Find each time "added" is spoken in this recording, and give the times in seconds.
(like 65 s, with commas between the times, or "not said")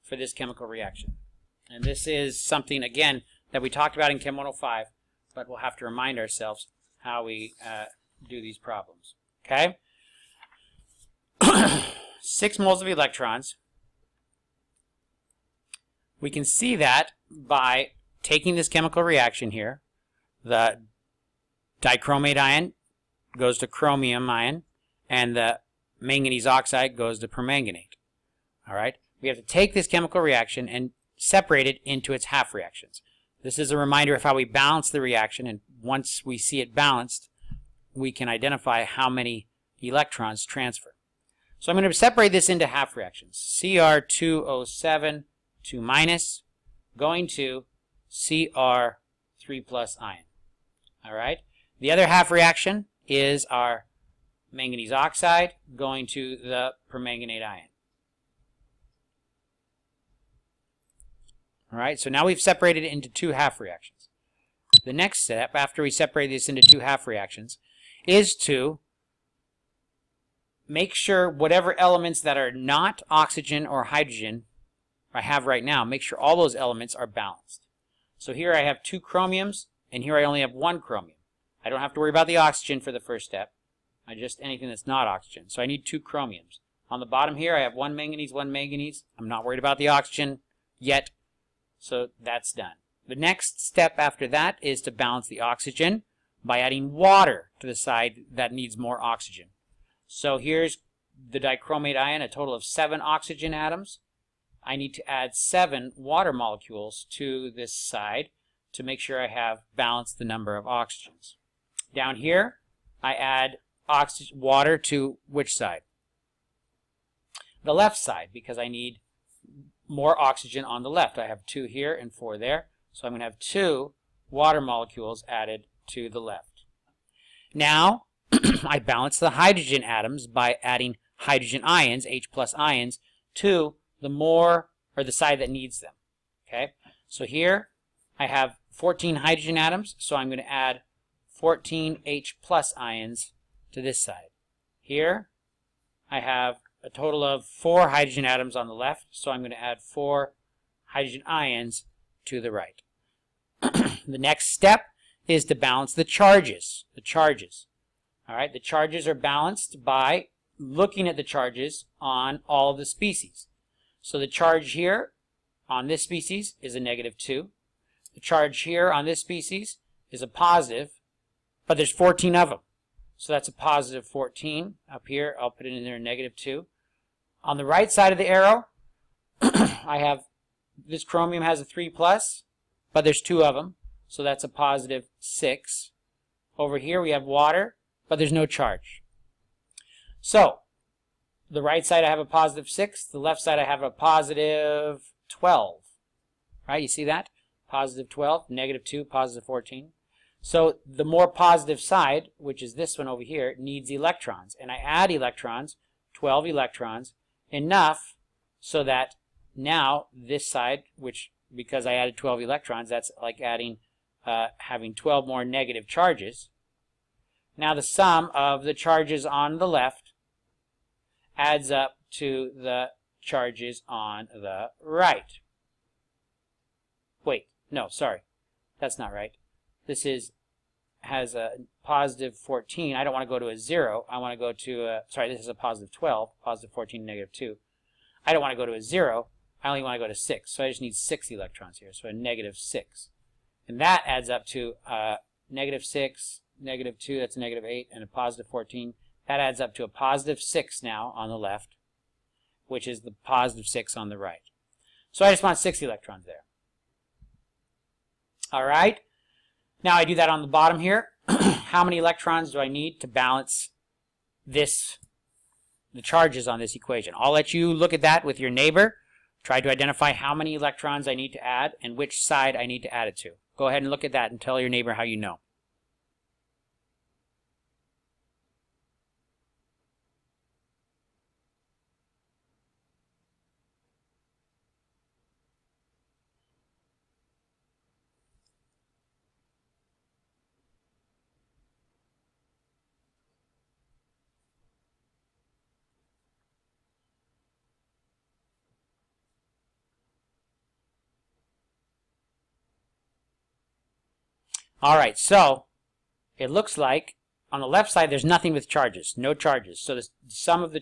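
125 s, 211 s.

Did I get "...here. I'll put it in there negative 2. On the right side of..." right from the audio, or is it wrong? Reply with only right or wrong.
right.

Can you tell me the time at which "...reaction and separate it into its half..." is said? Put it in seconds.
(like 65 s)
30 s.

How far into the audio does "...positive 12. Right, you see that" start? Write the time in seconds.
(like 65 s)
193 s.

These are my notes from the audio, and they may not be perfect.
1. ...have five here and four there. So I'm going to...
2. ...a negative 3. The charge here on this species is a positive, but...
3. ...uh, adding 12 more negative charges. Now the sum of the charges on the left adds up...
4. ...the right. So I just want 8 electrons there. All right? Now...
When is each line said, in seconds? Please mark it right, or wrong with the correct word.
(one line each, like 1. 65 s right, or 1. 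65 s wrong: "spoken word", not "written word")
1. 121 s wrong: "two", not "five"
2. 166 s wrong: "2", not "3"
3. 214 s wrong: "having", not "adding"
4. 254 s wrong: "6", not "8".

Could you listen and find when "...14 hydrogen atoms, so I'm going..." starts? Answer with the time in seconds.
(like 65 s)
138 s.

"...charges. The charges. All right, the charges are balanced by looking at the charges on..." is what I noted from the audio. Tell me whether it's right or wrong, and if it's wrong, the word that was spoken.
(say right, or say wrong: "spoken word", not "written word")
right.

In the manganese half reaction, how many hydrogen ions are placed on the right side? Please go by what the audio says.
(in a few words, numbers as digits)
4.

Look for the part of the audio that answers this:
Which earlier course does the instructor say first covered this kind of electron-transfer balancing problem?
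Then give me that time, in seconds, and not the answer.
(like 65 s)
4 s.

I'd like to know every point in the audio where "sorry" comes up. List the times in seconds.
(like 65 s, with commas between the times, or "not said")
227 s, 235 s.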